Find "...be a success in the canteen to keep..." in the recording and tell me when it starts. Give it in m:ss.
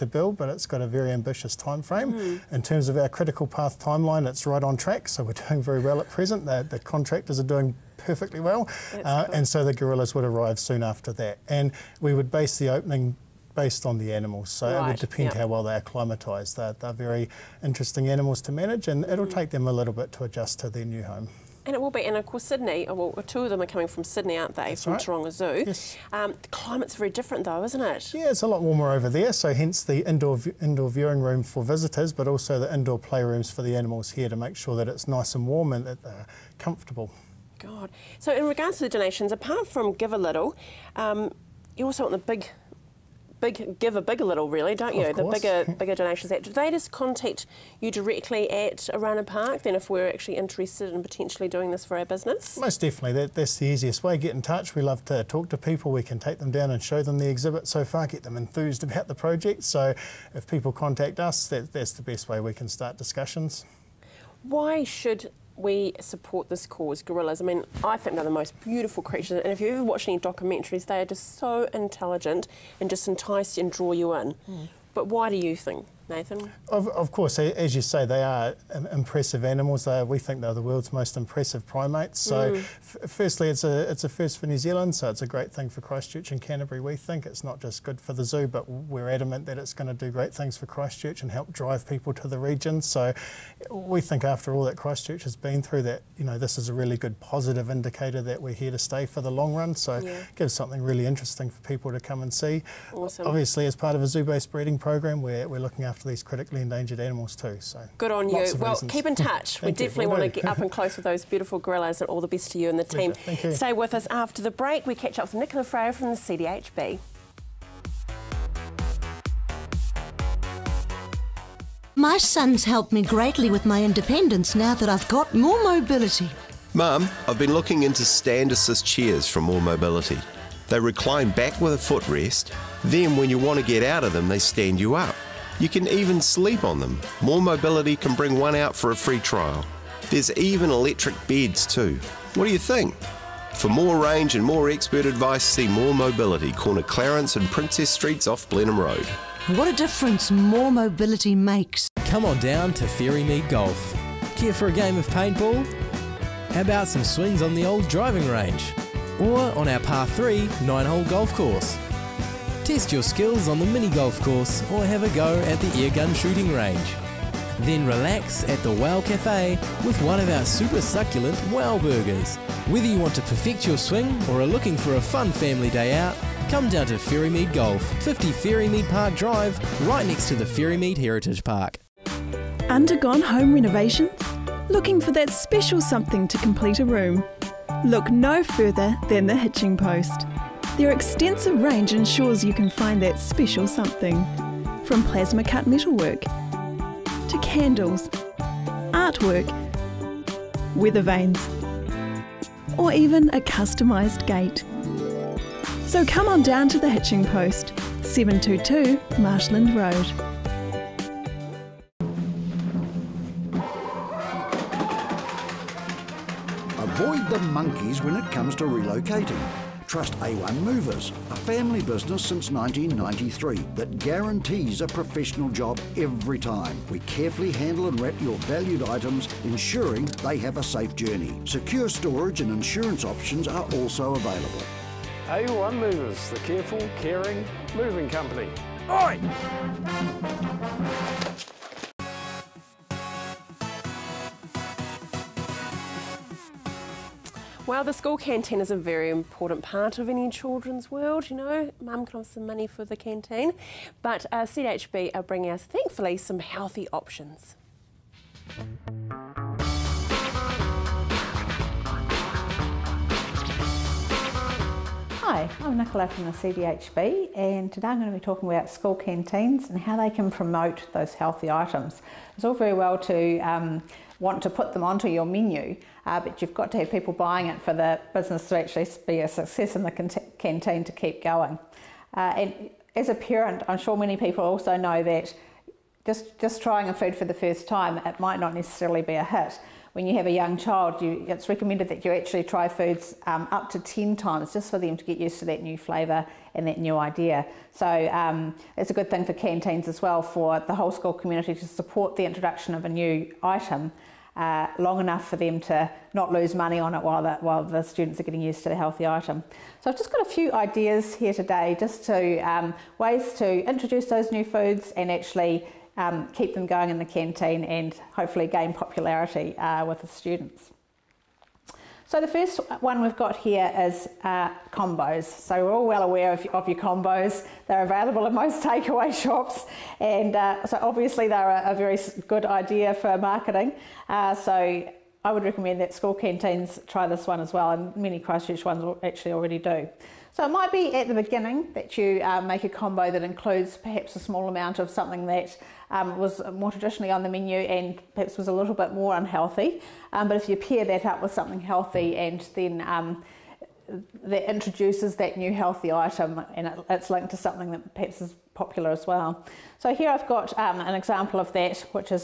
4:39.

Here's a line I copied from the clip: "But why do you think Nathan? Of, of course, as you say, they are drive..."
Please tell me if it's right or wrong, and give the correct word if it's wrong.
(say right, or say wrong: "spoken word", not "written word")
wrong: "impressive", not "drive".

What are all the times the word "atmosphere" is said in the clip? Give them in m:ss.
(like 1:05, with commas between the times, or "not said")
not said.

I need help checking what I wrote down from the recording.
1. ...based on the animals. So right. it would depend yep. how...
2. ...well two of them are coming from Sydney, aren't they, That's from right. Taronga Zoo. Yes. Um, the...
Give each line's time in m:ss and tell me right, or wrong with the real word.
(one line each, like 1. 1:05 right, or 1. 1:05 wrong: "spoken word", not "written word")
1. 0:13 right
2. 0:22 right.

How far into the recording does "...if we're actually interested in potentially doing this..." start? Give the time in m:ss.
0:49.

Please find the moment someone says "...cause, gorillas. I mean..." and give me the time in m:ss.
1:06.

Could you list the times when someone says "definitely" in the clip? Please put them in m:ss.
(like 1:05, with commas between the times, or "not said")
0:52, 1:49.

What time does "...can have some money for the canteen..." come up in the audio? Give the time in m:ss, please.
4:12.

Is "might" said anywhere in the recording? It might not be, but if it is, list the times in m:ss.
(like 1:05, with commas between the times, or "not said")
4:48, 5:40.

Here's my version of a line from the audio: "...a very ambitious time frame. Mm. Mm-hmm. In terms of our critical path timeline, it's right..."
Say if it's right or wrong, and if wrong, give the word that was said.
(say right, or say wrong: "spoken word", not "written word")
right.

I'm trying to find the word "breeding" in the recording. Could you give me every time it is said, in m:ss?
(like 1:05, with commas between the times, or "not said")
1:44.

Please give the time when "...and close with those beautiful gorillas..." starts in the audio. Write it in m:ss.
1:50.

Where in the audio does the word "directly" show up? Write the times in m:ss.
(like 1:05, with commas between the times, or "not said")
0:47.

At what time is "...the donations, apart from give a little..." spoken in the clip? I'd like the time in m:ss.
0:38.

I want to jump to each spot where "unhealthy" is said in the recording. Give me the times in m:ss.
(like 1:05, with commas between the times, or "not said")
5:49.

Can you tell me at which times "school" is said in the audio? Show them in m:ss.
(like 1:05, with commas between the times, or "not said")
4:07, 4:28, 5:00, 5:35.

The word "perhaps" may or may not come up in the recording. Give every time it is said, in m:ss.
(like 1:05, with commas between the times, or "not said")
5:43, 5:48, 5:57.